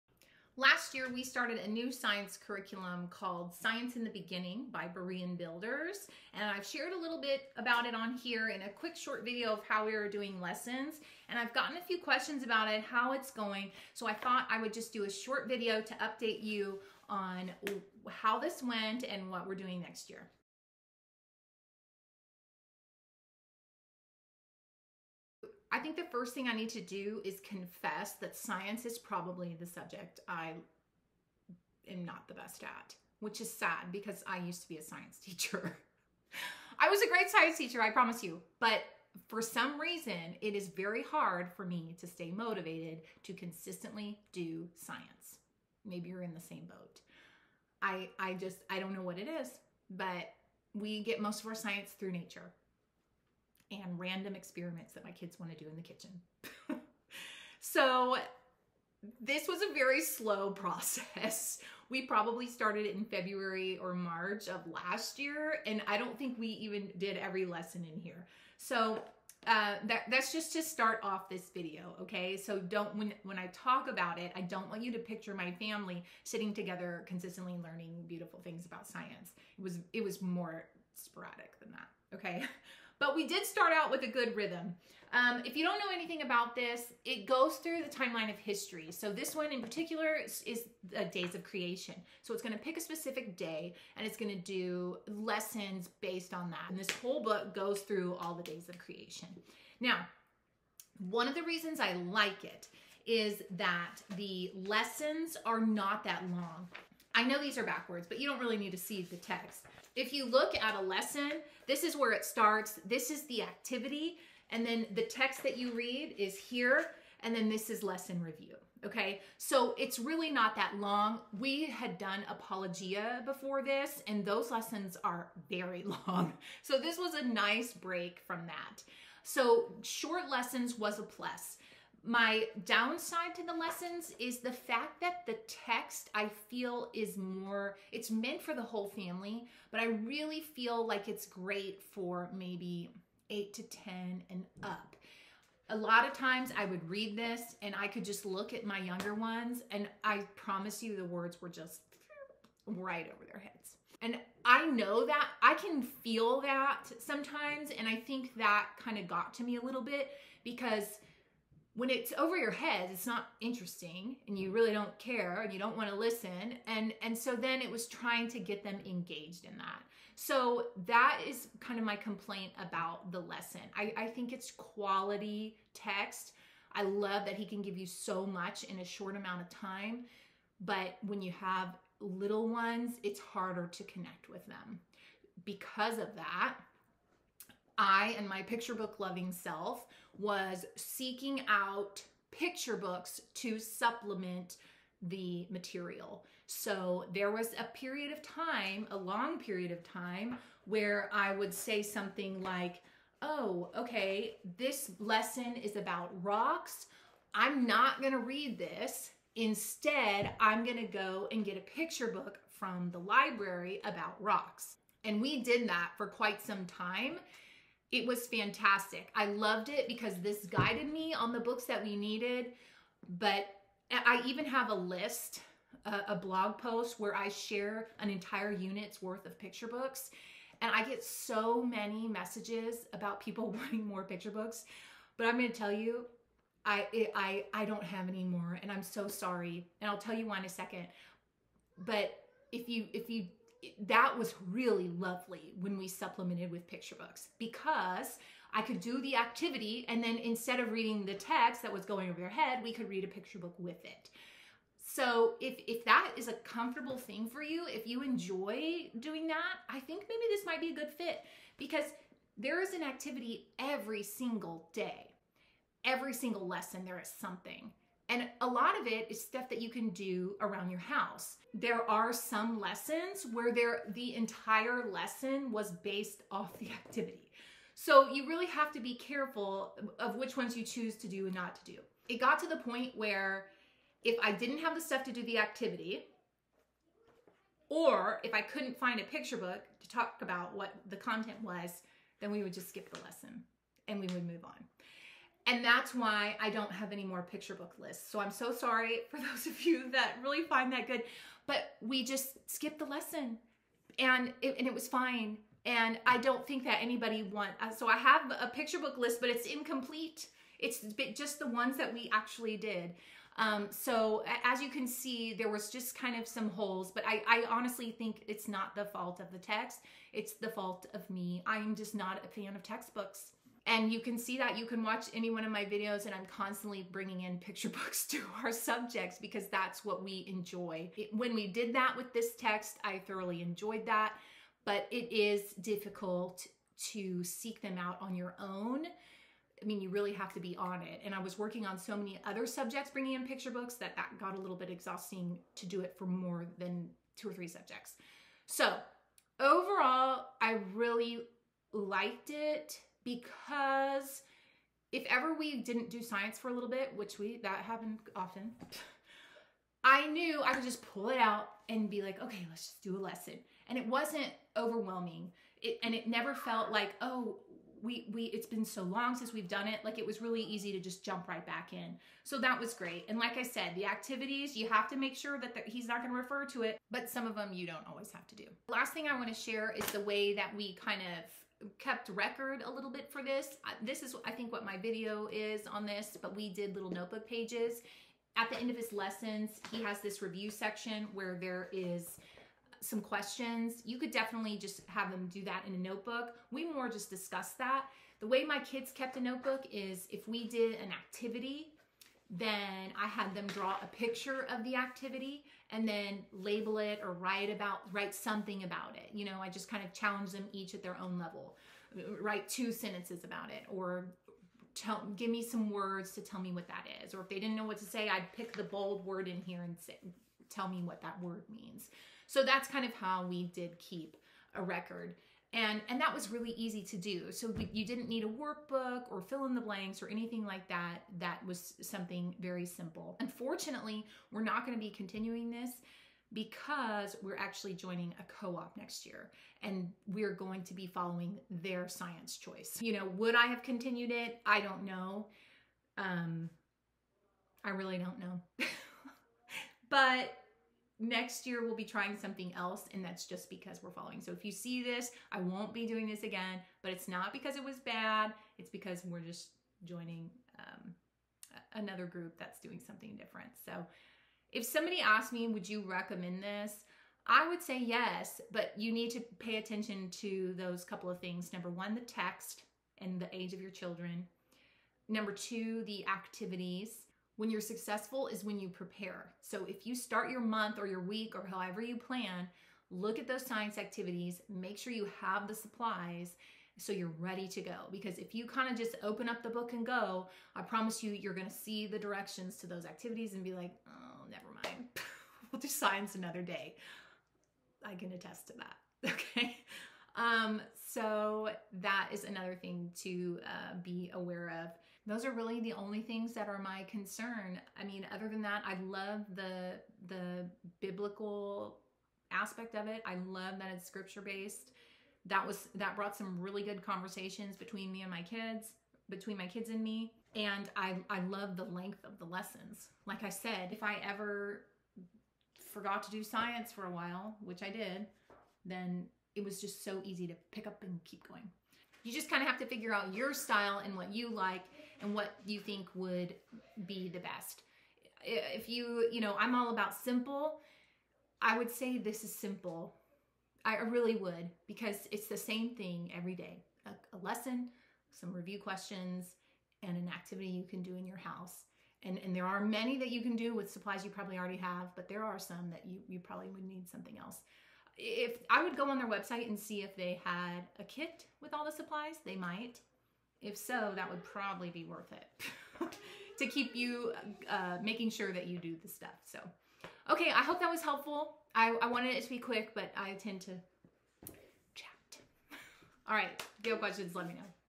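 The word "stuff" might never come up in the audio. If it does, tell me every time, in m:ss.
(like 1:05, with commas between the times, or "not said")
4:29, 4:44, 9:28.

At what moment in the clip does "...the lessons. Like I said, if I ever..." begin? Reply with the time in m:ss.
8:42.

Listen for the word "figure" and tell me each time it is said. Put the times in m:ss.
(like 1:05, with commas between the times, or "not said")
8:52.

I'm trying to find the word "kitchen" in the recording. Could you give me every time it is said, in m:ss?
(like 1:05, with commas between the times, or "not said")
0:55.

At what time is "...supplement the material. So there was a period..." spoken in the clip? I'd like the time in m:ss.
3:13.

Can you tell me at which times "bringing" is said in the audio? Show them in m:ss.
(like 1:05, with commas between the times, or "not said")
5:26, 5:42.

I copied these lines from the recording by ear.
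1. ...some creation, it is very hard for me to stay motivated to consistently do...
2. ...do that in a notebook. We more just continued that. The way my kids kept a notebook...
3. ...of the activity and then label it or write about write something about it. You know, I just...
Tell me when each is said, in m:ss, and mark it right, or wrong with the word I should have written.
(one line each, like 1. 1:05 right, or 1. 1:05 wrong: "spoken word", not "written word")
1. 0:39 wrong: "reason", not "creation"
2. 6:35 wrong: "discussed", not "continued"
3. 6:44 right.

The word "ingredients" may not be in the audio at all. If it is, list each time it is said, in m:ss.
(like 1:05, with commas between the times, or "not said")
not said.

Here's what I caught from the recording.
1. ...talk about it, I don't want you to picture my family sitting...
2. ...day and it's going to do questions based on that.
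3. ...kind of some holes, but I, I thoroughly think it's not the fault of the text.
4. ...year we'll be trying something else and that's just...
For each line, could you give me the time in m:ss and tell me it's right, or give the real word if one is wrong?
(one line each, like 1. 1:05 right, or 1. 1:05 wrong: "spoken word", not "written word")
1. 1:13 right
2. 1:33 wrong: "lessons", not "questions"
3. 5:15 wrong: "honestly", not "thoroughly"
4. 7:31 right.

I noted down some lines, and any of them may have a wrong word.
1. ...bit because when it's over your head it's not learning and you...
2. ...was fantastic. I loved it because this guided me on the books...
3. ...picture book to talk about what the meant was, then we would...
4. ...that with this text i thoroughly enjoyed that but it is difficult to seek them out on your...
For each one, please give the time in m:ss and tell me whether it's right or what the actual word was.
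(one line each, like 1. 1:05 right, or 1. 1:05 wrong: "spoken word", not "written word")
1. 2:39 wrong: "interesting", not "learning"
2. 3:38 right
3. 4:49 wrong: "content", not "meant"
4. 5:31 right.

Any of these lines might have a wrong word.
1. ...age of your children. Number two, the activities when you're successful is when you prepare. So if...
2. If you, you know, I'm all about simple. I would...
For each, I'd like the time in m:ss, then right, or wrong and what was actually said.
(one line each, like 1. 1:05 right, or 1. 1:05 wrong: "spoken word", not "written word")
1. 7:53 right
2. 8:58 right.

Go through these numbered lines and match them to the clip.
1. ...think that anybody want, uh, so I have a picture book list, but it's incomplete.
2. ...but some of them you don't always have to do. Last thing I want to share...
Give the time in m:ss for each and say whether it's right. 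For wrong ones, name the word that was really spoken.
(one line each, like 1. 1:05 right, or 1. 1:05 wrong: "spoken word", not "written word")
1. 5:06 right
2. 6:16 right.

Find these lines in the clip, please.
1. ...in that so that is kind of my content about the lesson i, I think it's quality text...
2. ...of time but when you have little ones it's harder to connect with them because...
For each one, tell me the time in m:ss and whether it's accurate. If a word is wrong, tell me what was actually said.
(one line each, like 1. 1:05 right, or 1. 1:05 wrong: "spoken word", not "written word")
1. 2:49 wrong: "complaint", not "content"
2. 2:59 right.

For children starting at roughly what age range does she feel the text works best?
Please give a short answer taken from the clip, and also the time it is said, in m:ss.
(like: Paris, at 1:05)
8 to 10 and up, at 2:23.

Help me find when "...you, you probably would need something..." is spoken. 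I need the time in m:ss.
9:15.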